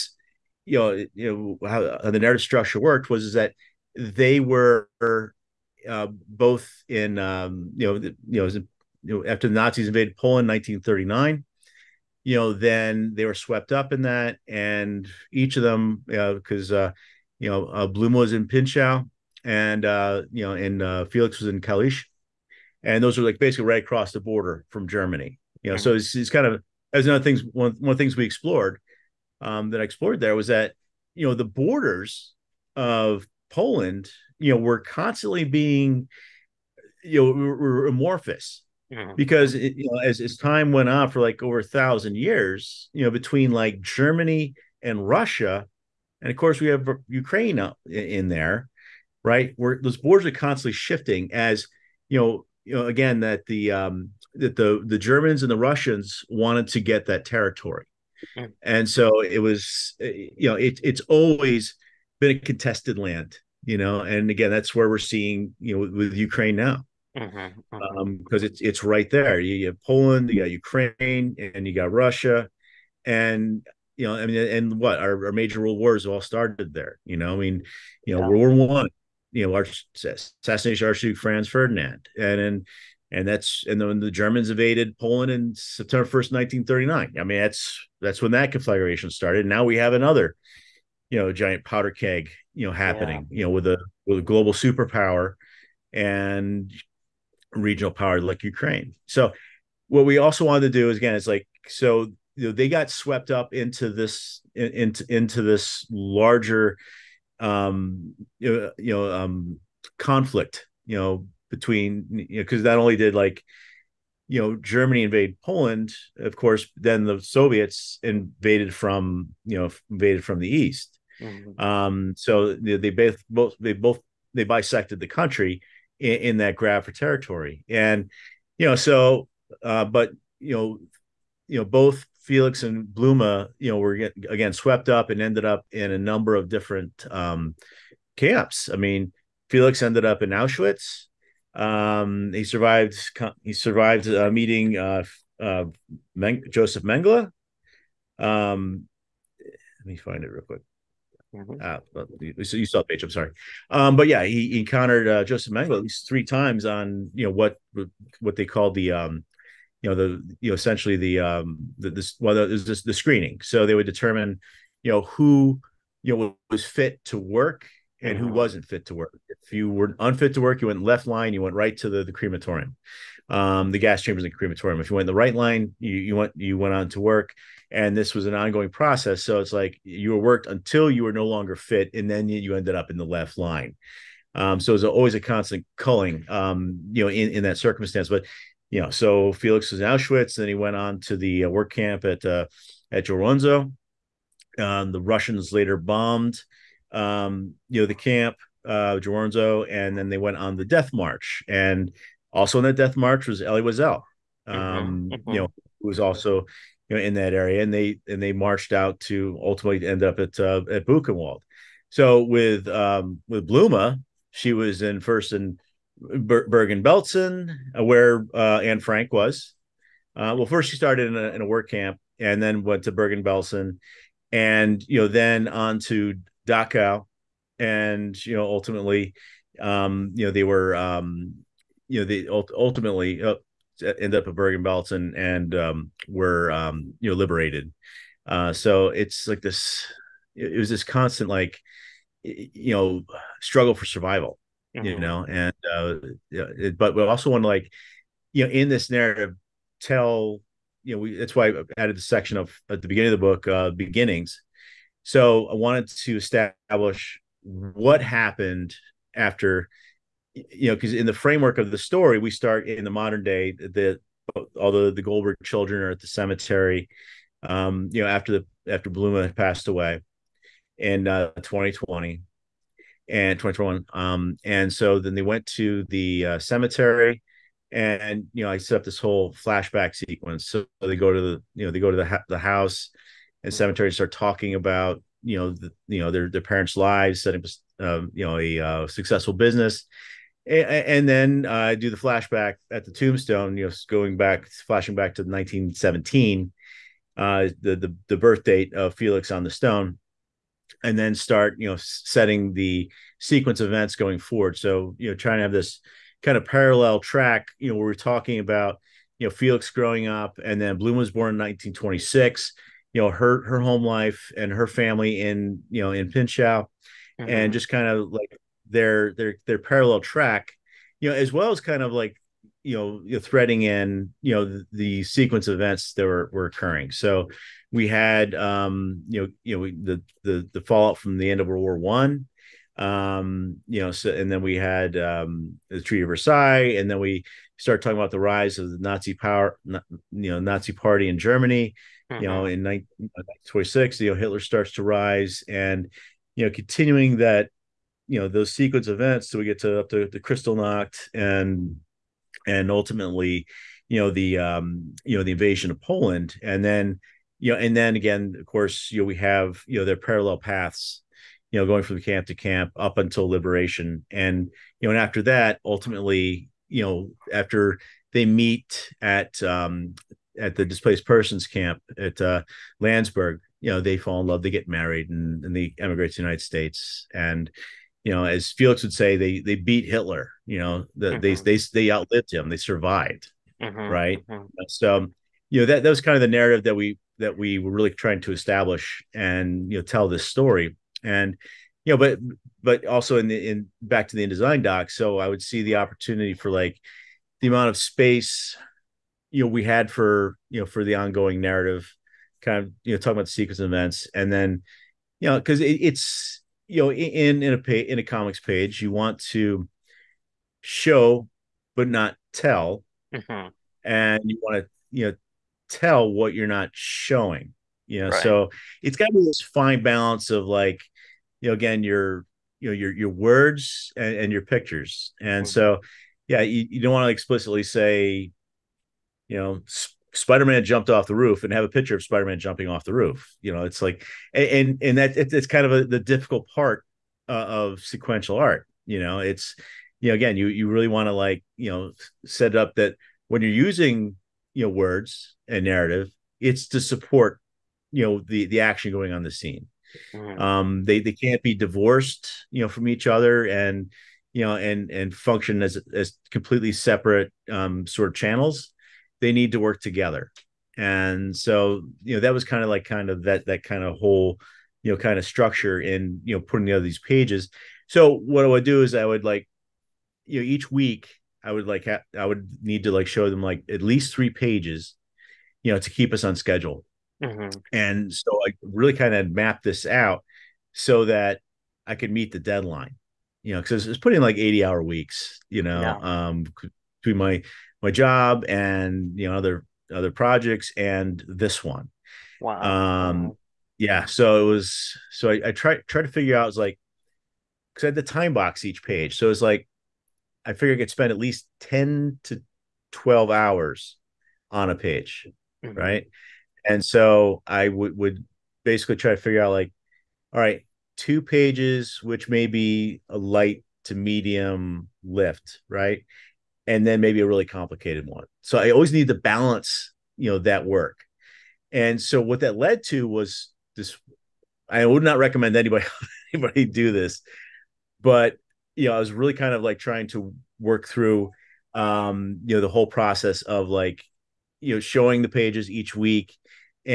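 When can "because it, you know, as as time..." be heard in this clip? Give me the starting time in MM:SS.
00:39.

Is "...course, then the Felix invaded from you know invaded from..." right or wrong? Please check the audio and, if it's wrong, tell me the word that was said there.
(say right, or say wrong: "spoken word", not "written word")
wrong: "Soviets", not "Felix".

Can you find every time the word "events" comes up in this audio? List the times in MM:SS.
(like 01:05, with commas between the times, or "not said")
05:03, 05:25, 05:48, 06:43.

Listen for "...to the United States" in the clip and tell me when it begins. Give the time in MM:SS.
06:16.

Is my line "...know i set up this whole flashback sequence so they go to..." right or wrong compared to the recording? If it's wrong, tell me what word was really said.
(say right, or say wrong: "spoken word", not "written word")
right.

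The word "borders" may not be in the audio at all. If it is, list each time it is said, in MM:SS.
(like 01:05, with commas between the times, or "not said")
00:24, 00:31, 00:49.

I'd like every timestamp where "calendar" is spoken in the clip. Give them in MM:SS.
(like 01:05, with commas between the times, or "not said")
not said.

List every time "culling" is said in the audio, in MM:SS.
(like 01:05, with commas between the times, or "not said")
03:05.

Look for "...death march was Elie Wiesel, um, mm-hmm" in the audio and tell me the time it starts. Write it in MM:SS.
03:22.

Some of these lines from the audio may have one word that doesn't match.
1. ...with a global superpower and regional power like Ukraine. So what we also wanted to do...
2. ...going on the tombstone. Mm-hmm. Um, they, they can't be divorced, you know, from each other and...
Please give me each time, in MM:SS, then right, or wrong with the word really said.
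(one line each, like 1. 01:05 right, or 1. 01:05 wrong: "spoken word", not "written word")
1. 01:34 right
2. 07:28 wrong: "scene", not "tombstone".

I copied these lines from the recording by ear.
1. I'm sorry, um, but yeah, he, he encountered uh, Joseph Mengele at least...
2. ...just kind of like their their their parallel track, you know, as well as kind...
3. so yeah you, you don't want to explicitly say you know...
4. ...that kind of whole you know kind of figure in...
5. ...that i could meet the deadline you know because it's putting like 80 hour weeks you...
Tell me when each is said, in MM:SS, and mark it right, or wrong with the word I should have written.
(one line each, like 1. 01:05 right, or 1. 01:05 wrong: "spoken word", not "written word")
1. 02:33 right
2. 05:17 right
3. 07:05 right
4. 07:43 wrong: "structure", not "figure"
5. 08:01 right.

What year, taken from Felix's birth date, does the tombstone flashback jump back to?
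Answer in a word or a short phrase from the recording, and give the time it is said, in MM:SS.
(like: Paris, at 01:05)
1917, at 04:55.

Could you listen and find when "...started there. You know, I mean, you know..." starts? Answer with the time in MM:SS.
01:16.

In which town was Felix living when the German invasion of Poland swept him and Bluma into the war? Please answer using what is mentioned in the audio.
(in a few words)
Kalisz.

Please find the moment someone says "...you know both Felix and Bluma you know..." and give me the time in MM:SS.
02:11.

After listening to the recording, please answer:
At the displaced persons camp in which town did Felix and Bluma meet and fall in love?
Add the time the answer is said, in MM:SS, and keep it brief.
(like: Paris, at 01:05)
Landsberg, at 06:12.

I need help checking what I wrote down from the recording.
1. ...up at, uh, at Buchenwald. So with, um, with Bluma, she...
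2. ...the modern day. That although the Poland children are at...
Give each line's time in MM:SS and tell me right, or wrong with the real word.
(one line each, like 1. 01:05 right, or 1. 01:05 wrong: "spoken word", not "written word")
1. 03:30 right
2. 04:22 wrong: "Goldberg", not "Poland".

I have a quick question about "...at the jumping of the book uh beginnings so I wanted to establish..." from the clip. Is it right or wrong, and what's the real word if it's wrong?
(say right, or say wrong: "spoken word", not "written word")
wrong: "beginning", not "jumping".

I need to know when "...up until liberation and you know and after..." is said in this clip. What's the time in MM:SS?
06:02.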